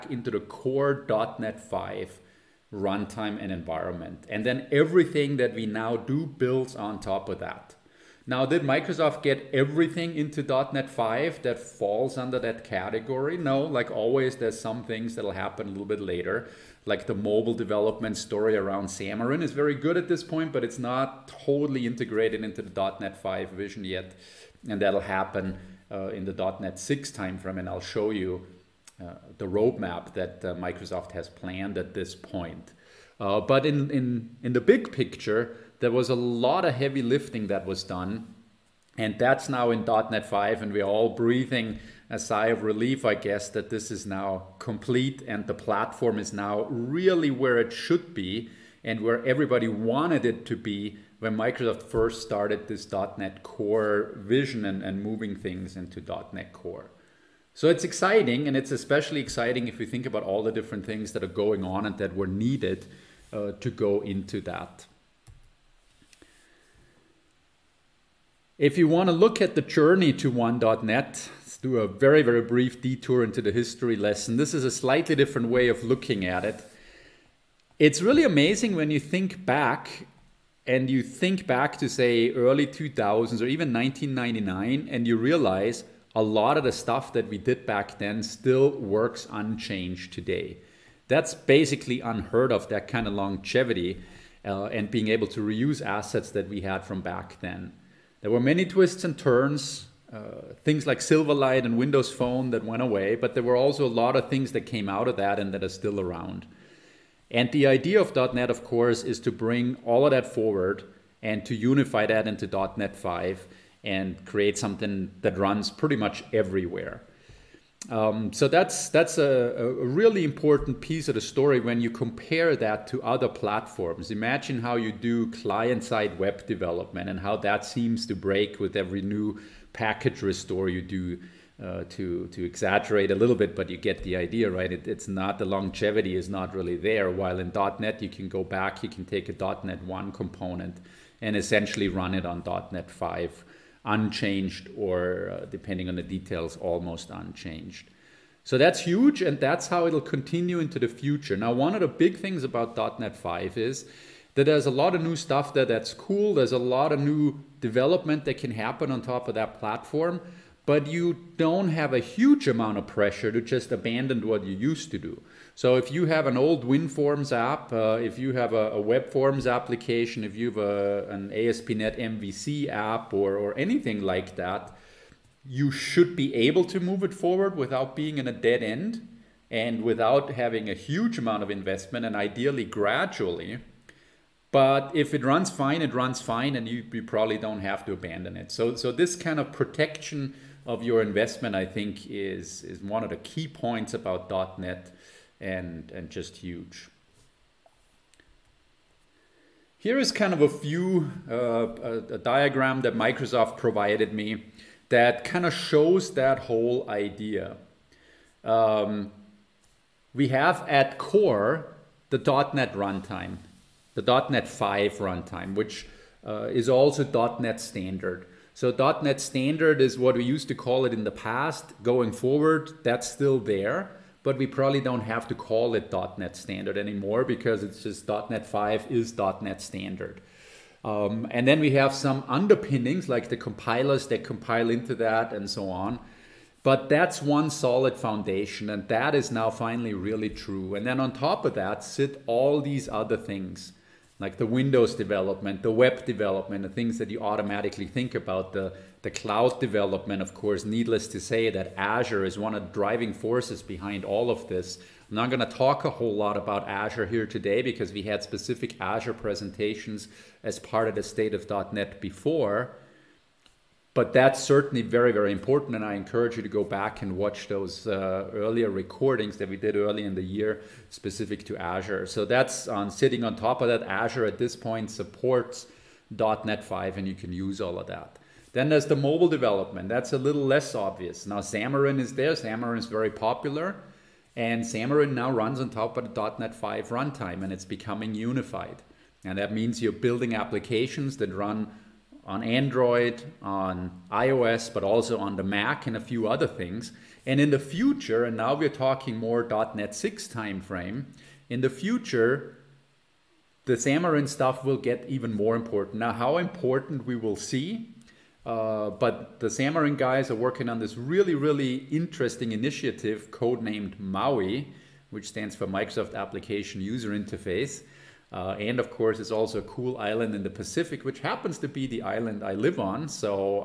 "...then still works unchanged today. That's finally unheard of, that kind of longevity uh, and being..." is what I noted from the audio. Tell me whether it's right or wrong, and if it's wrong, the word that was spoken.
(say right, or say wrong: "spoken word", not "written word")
wrong: "basically", not "finally".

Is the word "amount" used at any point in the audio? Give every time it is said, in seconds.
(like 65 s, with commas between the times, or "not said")
162 s, 181 s.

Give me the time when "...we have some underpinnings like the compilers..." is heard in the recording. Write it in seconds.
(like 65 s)
231 s.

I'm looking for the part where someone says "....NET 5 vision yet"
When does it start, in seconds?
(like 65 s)
22 s.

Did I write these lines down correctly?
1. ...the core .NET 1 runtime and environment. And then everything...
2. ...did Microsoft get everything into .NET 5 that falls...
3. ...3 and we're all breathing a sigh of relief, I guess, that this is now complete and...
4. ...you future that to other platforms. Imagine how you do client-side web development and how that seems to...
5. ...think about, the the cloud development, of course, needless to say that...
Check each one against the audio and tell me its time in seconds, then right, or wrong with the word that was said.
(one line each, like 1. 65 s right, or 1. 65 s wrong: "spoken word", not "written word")
1. 0 s wrong: "5", not "1"
2. 8 s right
3. 40 s wrong: "5", not "3"
4. 121 s wrong: "compare", not "future"
5. 247 s right.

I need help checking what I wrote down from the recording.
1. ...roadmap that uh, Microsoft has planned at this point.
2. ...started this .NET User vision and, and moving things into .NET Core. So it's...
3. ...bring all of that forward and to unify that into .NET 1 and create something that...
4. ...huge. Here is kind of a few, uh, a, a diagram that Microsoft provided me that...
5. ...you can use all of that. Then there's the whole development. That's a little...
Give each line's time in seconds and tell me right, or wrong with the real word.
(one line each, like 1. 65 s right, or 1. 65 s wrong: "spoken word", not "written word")
1. 29 s right
2. 52 s wrong: "Core", not "User"
3. 109 s wrong: "5", not "1"
4. 196 s right
5. 277 s wrong: "mobile", not "whole".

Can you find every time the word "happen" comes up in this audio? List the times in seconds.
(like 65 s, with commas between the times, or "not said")
15 s, 25 s, 158 s, 321 s.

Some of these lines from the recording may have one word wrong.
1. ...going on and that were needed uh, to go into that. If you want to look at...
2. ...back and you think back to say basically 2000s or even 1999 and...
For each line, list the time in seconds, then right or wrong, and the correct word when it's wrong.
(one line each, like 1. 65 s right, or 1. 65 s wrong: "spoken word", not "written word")
1. 61 s right
2. 79 s wrong: "early", not "basically".